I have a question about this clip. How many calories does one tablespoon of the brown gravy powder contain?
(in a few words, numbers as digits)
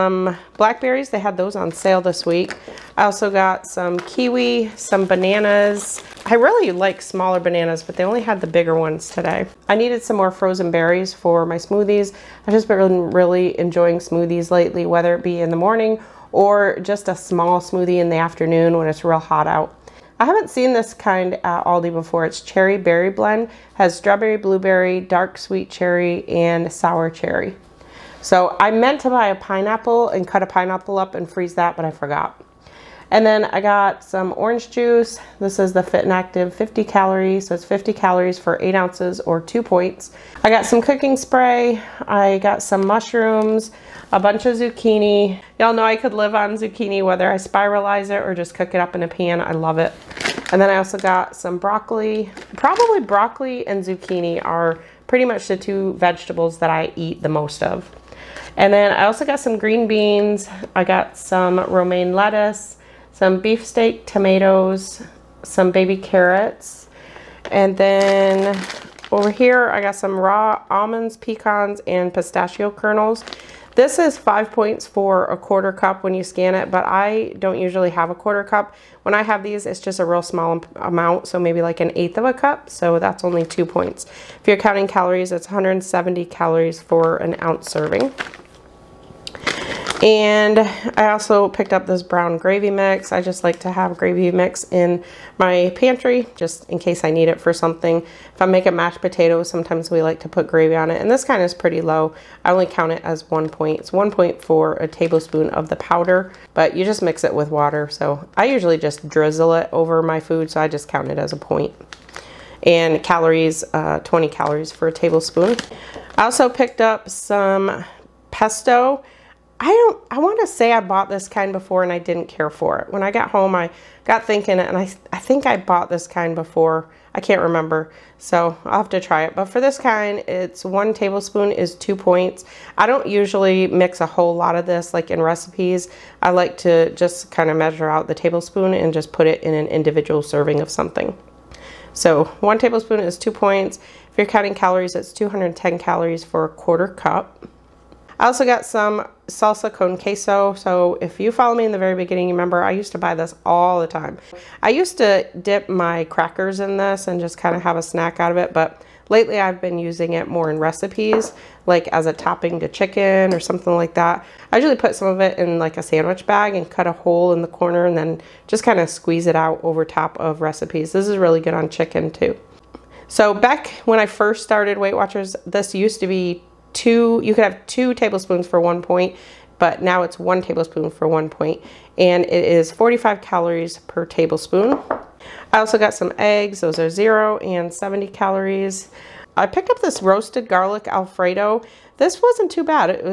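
20.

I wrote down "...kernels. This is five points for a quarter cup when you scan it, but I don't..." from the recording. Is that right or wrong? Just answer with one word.
right.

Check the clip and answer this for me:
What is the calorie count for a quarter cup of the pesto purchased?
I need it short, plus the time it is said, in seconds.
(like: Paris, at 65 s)
210, at 145 s.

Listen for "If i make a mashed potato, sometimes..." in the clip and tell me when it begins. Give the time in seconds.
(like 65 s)
98 s.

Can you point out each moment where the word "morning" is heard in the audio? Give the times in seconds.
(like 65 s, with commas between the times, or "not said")
15 s.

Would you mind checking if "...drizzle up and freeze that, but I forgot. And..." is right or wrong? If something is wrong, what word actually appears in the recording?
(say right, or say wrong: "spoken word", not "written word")
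wrong: "pineapple", not "drizzle".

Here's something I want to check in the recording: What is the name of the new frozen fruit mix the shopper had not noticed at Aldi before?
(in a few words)
cherry berry blend.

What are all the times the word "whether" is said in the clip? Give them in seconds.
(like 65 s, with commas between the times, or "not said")
14 s, 47 s.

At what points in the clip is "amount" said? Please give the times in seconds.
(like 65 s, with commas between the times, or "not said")
80 s.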